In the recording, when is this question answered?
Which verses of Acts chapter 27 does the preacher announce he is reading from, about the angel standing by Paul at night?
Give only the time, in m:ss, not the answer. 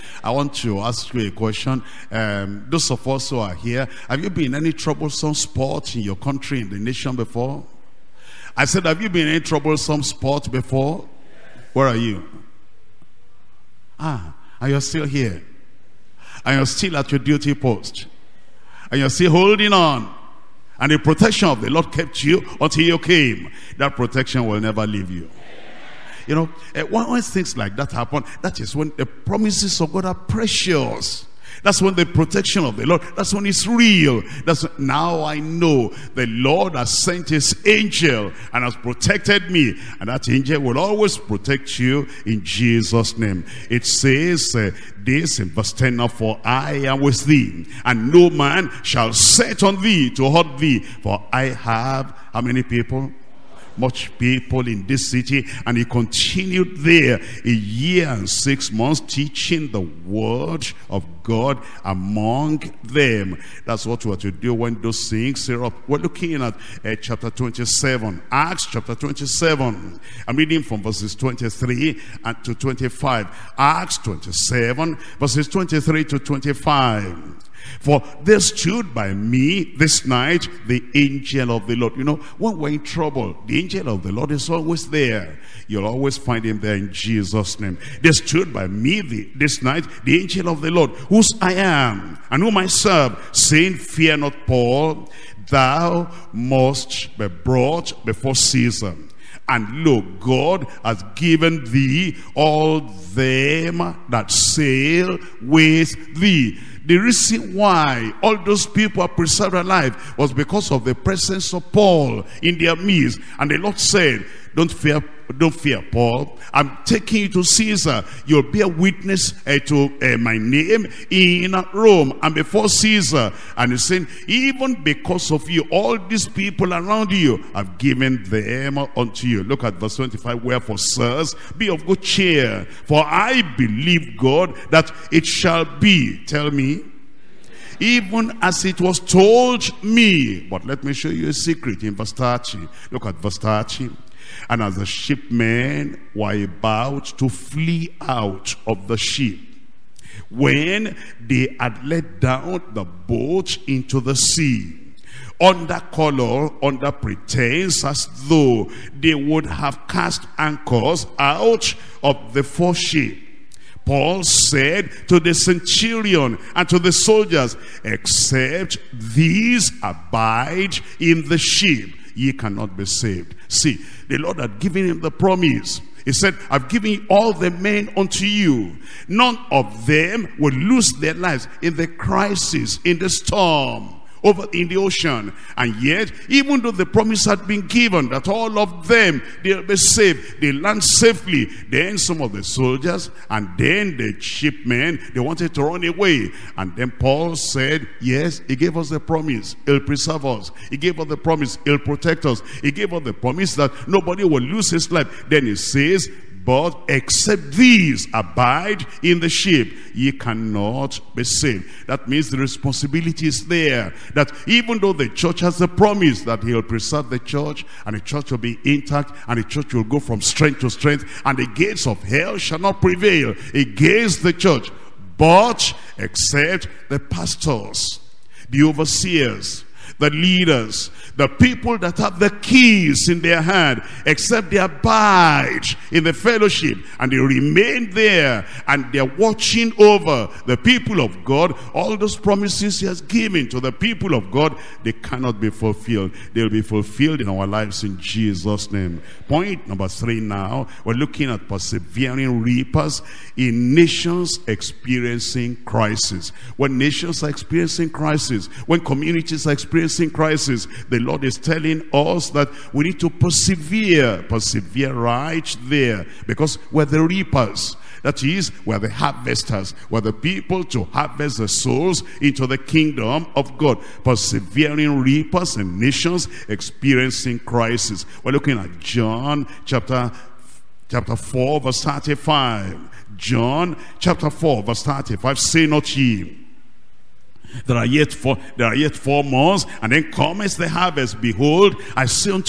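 1:15.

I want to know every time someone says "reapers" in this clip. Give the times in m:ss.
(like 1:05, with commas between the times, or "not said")
4:12, 4:27, 4:35.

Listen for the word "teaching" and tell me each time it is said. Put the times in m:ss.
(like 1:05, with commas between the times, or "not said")
0:59.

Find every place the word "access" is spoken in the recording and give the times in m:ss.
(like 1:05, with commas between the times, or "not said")
not said.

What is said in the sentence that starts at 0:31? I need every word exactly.
That's when the protection of the Lord, that's when it's real.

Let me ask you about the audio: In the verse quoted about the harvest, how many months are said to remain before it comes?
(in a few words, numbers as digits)
4.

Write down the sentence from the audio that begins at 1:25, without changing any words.
You'll always find him there in Jesus' name.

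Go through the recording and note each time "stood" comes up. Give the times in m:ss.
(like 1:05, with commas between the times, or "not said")
1:18, 1:28.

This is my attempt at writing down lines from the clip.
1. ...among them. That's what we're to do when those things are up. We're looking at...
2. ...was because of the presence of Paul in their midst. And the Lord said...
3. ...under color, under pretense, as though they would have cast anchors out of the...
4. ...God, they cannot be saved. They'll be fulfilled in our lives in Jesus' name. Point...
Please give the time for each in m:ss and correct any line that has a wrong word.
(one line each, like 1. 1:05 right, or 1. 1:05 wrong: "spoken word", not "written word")
1. 1:01 right
2. 1:50 right
3. 2:35 right
4. 4:04 wrong: "fulfilled", not "saved".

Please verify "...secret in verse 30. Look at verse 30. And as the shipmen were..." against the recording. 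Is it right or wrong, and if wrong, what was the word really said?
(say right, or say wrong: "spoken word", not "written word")
right.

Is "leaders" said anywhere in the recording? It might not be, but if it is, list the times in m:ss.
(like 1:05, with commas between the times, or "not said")
3:50.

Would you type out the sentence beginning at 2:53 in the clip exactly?
See, the Lord had given him the promise.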